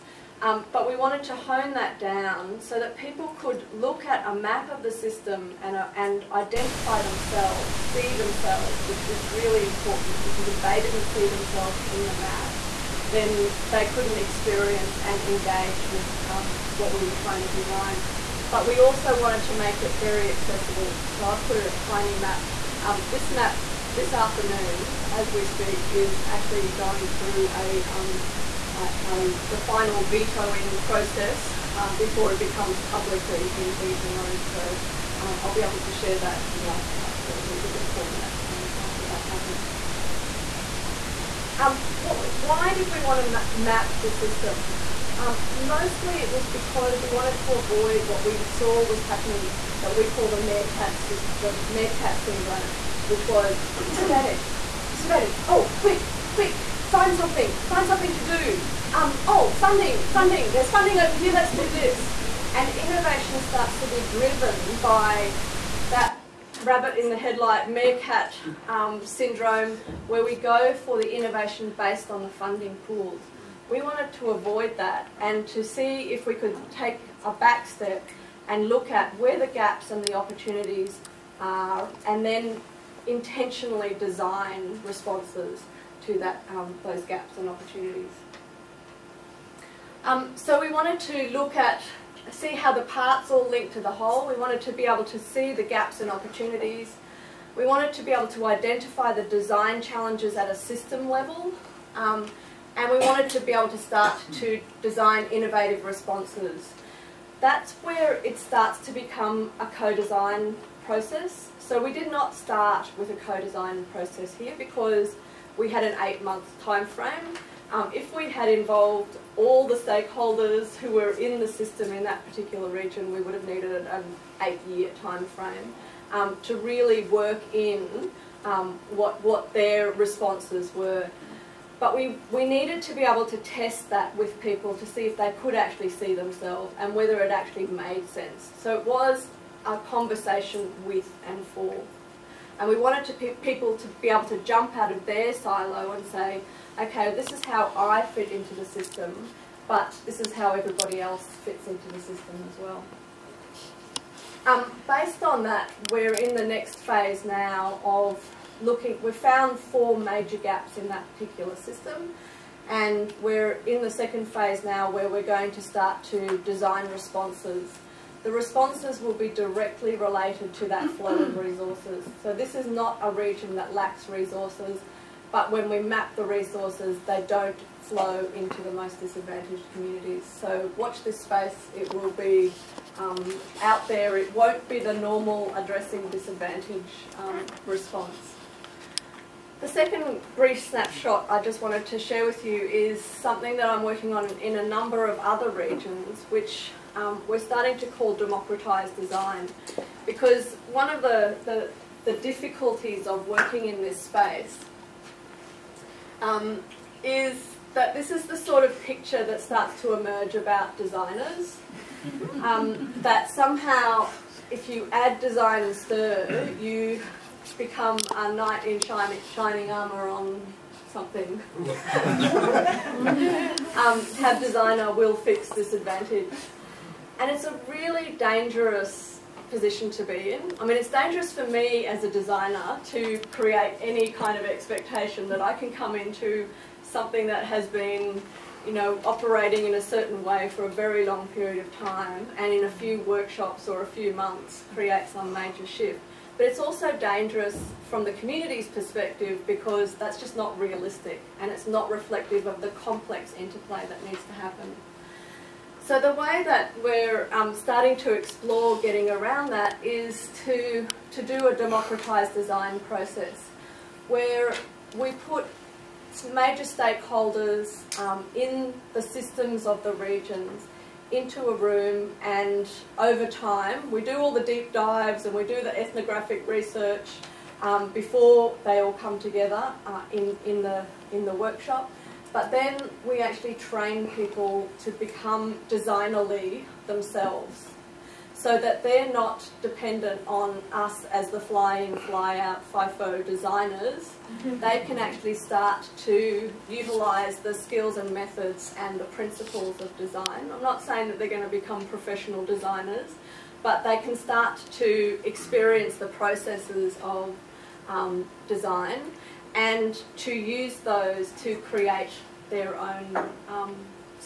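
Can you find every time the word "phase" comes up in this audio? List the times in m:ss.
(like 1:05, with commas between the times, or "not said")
2:36, 2:44.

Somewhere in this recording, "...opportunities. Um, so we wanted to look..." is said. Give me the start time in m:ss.
1:27.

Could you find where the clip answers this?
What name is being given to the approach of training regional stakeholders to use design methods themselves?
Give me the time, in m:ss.
3:18.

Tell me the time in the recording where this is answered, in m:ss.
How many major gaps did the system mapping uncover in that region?
2:39.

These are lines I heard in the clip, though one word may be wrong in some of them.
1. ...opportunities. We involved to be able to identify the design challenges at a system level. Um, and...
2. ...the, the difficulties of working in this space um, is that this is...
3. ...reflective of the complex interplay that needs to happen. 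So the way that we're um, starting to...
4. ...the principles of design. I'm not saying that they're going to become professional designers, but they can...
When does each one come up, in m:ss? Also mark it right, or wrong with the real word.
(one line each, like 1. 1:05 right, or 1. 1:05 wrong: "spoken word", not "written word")
1. 1:36 wrong: "wanted", not "involved"
2. 3:21 right
3. 4:11 right
4. 4:59 right.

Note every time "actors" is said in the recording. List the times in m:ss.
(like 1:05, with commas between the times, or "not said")
not said.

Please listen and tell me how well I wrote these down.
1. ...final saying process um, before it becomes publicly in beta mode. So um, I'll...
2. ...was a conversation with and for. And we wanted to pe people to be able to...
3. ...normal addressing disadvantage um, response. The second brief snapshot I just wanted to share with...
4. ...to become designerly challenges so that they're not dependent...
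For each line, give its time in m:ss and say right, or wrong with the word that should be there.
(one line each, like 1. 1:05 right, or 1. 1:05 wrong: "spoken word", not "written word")
1. 0:29 wrong: "vetoing", not "saying"
2. 2:18 right
3. 3:04 right
4. 4:44 wrong: "themselves", not "challenges".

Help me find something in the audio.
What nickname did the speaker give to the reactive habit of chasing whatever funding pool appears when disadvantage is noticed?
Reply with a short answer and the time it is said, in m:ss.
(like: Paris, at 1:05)
meerkat syndrome, at 0:51.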